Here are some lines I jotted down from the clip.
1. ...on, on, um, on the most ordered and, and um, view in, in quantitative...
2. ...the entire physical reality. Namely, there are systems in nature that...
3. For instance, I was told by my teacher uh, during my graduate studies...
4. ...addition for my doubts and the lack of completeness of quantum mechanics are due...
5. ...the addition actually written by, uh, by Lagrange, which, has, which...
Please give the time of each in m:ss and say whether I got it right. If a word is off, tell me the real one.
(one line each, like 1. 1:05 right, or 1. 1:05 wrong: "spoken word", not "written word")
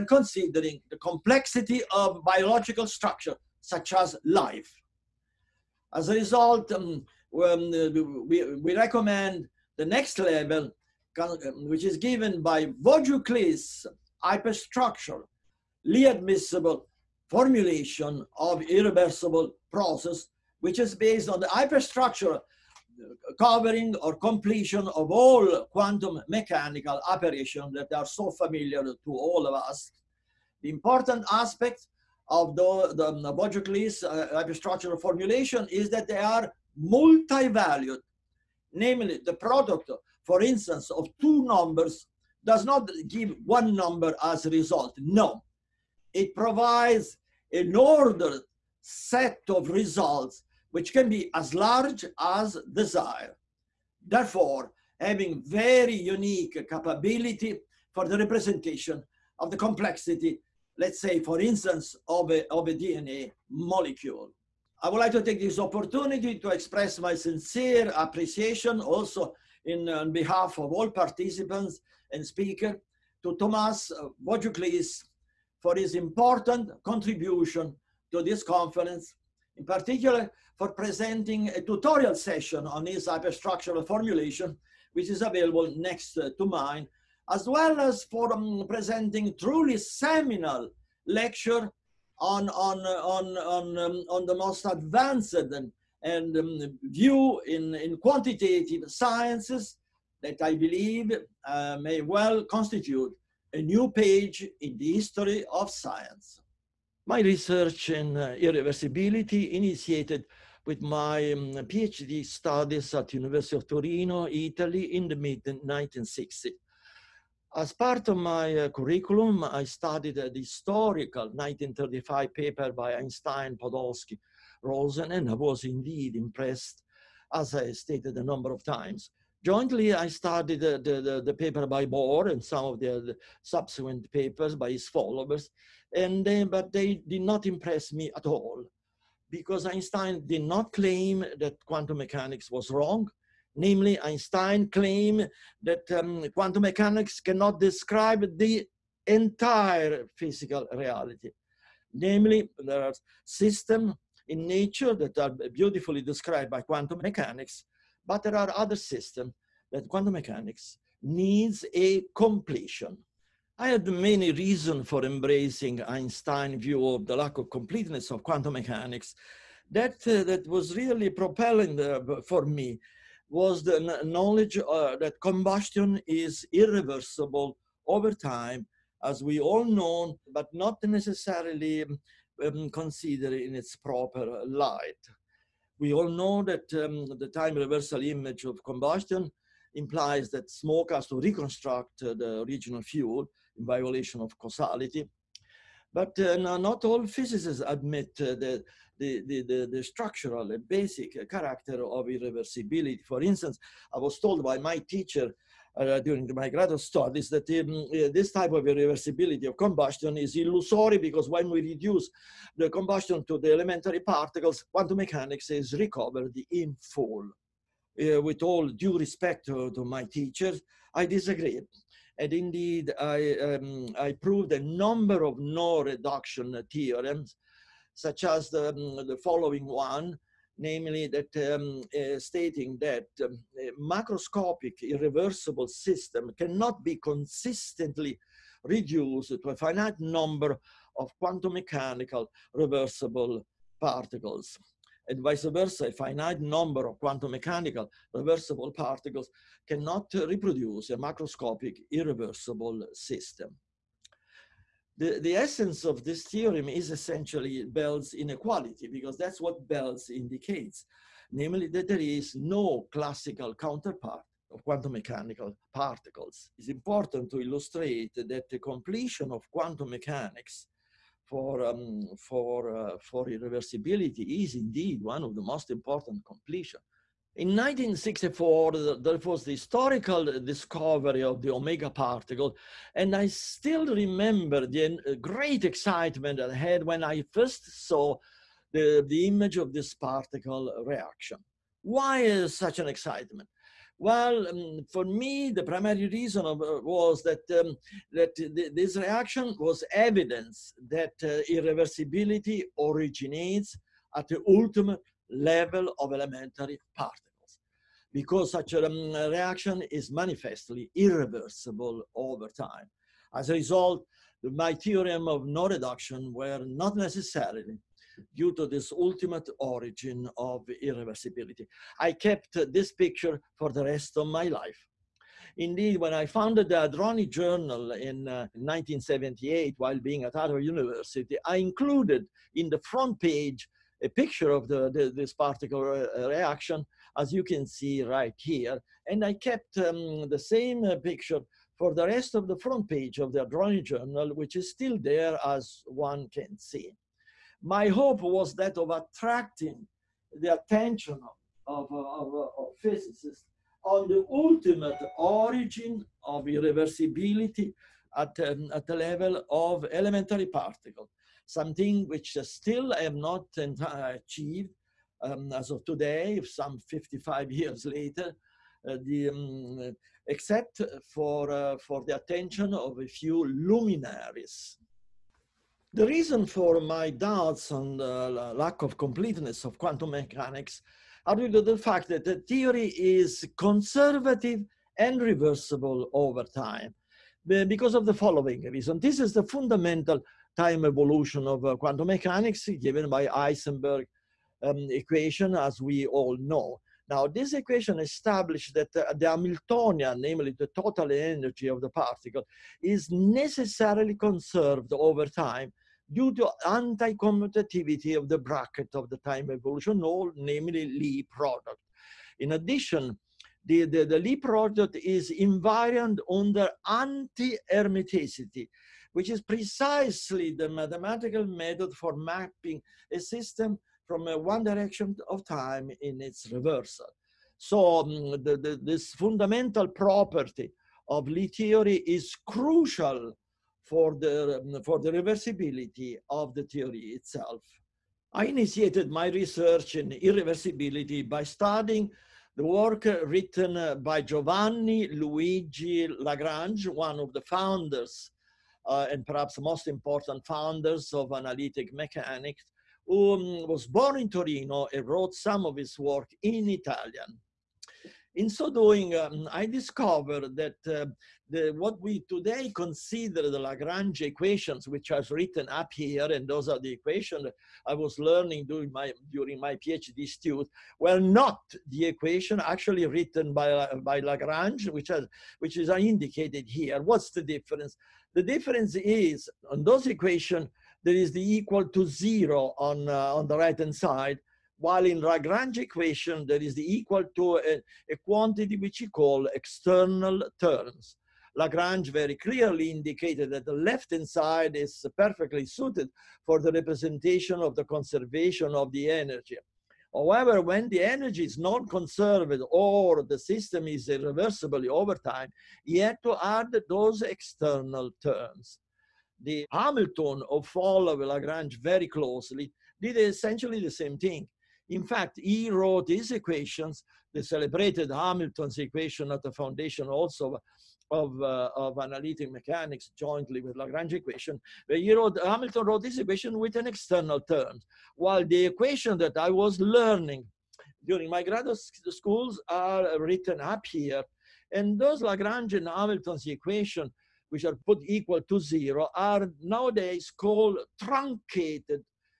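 1. 1:32 wrong: "advanced", not "ordered"
2. 2:28 right
3. 3:23 right
4. 6:16 wrong: "reason", not "addition"
5. 7:51 wrong: "equation", not "addition".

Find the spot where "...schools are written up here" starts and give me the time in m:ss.
8:52.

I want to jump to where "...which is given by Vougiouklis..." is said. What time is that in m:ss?
0:11.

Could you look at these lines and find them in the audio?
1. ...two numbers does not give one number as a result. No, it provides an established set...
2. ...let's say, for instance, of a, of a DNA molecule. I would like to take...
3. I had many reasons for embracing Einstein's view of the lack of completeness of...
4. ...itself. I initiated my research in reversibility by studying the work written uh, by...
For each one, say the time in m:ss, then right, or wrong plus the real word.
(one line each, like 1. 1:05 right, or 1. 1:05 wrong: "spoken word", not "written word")
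1. 0:41 wrong: "ordered", not "established"
2. 1:00 right
3. 2:43 right
4. 7:16 wrong: "irreversibility", not "reversibility".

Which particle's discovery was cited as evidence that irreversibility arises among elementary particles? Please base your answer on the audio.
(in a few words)
omega particle.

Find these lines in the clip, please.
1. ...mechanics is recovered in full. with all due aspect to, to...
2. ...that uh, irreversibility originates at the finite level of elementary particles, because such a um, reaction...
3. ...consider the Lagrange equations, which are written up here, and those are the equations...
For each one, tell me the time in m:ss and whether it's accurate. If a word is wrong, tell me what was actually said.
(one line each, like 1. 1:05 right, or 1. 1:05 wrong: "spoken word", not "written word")
1. 3:34 wrong: "respect", not "aspect"
2. 5:00 wrong: "ultimate", not "finite"
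3. 7:42 right.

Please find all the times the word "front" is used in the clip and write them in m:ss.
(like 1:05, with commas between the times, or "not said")
5:32, 5:42.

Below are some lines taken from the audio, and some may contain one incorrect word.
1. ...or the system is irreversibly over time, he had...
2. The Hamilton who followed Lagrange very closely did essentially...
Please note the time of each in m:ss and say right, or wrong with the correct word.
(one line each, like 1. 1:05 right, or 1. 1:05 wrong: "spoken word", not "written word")
1. 8:22 right
2. 8:29 right.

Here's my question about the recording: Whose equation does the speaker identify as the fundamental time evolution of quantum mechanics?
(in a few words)
Heisenberg.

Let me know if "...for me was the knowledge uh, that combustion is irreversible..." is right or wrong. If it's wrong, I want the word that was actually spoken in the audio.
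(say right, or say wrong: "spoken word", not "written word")
right.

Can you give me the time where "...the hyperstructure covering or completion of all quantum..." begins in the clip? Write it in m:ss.
0:21.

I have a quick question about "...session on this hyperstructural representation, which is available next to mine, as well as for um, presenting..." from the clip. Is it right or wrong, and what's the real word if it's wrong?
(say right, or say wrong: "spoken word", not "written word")
wrong: "formulation", not "representation".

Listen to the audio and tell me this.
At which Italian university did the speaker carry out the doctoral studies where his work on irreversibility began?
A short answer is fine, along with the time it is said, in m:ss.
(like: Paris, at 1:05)
University of Torino, at 1:53.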